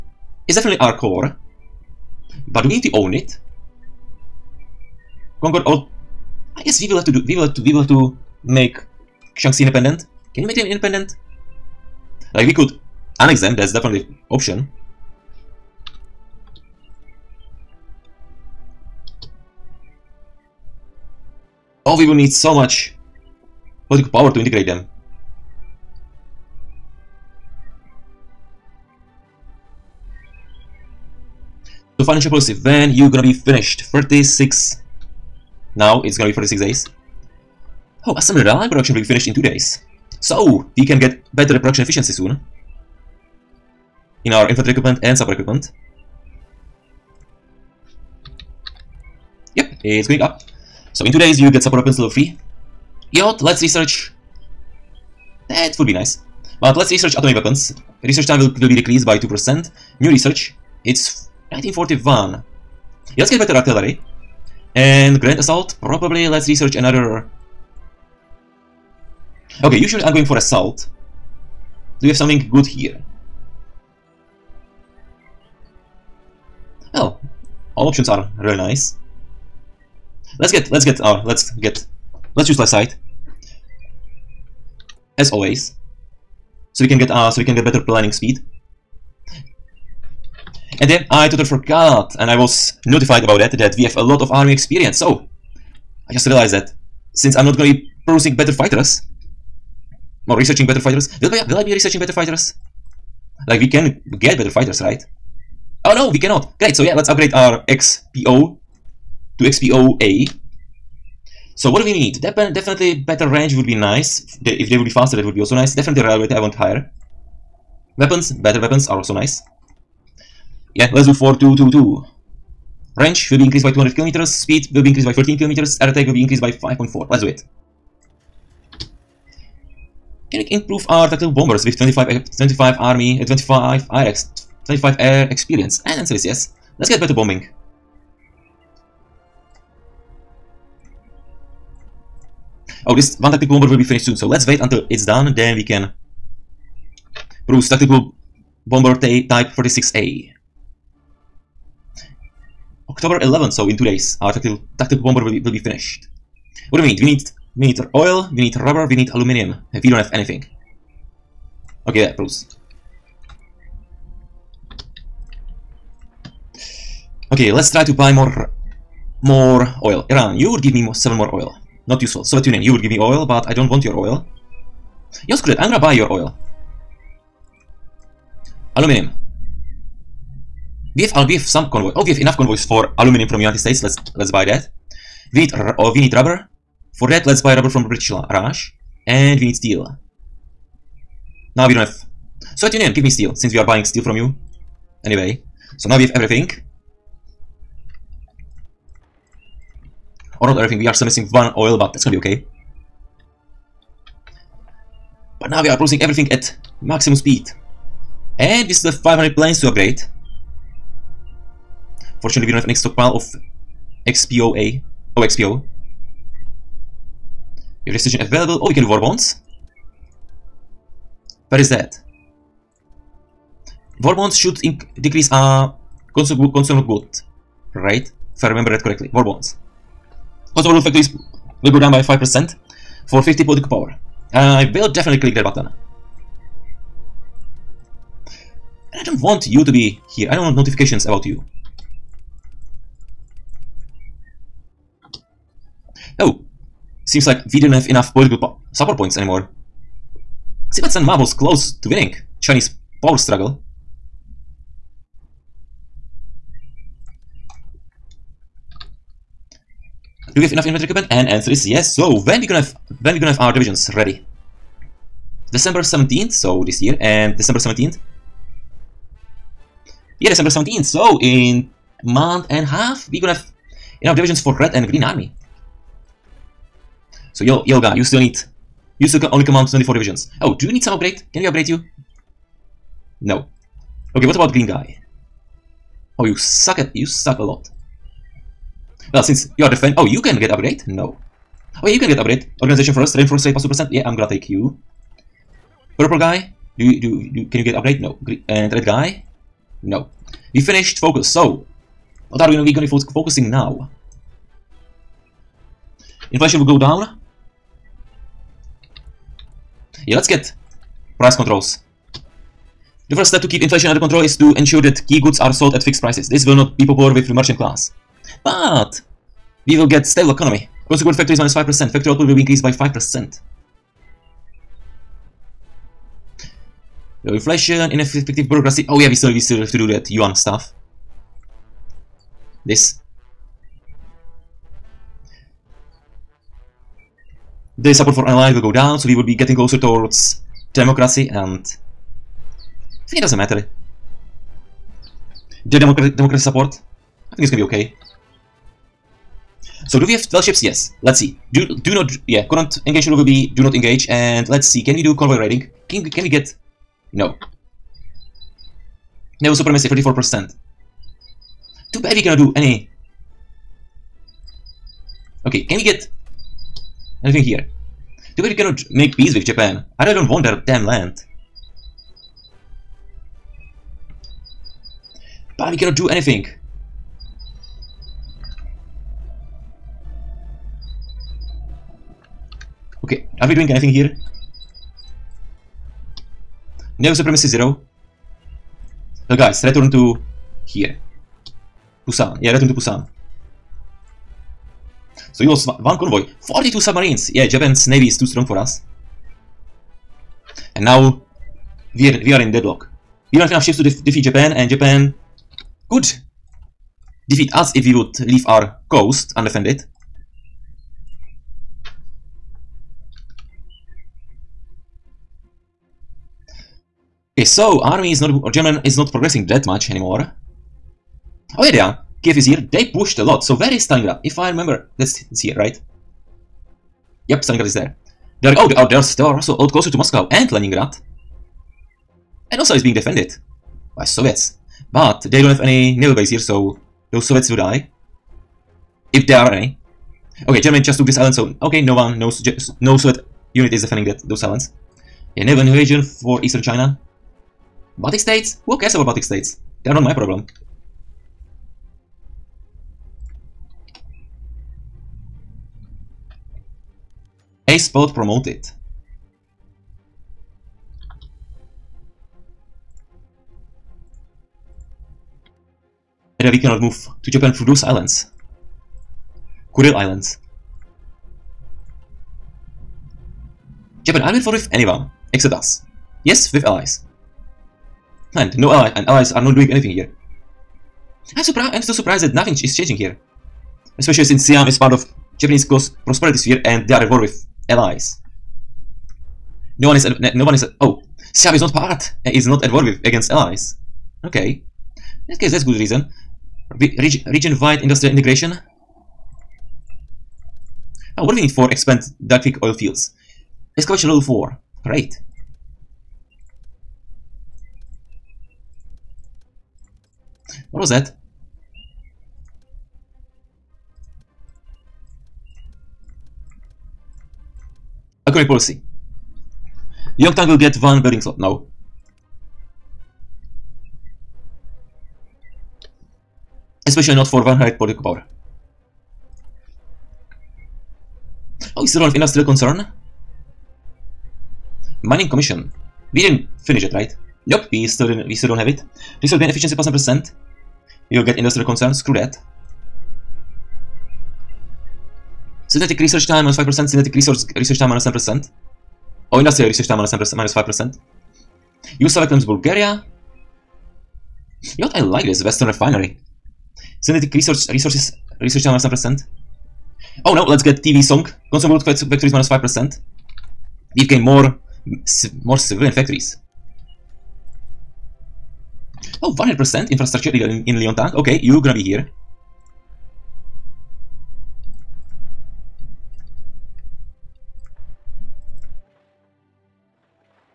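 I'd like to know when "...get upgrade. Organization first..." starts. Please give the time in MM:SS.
04:52.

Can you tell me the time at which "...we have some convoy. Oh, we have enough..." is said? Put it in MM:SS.
03:01.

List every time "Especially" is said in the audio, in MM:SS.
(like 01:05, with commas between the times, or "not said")
08:03, 08:46.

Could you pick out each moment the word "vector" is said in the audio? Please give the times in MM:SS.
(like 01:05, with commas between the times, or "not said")
09:22.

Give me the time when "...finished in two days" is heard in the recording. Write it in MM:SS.
00:39.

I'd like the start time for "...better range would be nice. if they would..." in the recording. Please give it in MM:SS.
01:53.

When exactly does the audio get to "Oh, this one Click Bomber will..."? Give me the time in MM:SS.
02:22.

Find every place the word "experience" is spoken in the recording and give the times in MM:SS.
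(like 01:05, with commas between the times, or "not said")
01:34, 02:15.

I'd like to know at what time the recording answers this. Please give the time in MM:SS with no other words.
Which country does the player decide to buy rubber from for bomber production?
03:07.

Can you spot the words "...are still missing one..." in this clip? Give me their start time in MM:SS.
03:20.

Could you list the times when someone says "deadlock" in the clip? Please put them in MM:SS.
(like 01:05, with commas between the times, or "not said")
06:42.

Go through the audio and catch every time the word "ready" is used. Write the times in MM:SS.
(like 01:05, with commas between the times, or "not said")
04:23.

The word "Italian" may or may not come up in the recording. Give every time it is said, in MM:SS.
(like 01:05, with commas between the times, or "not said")
not said.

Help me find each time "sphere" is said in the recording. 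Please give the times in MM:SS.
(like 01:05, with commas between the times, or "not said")
08:06.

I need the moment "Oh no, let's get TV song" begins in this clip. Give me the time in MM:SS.
09:20.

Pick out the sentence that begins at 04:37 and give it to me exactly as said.
So yo, Yoga, you still need, you still only command 24 divisions.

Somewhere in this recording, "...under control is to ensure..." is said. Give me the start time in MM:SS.
05:13.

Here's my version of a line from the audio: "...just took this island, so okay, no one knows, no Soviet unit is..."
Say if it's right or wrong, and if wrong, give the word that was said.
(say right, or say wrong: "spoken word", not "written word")
right.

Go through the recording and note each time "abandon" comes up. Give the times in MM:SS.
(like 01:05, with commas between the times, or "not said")
not said.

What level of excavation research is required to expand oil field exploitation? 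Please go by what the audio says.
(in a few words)
Excavation level 4.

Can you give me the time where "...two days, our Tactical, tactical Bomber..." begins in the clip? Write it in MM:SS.
02:33.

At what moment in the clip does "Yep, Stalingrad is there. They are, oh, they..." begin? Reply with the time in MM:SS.
07:07.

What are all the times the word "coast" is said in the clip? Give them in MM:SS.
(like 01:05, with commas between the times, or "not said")
06:48, 08:05.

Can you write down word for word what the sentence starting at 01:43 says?
Like we can get better fighters, right?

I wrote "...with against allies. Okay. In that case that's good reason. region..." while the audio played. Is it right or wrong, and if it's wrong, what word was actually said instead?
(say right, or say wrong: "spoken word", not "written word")
right.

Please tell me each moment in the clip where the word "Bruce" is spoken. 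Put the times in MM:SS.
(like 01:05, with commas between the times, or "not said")
02:27, 02:42.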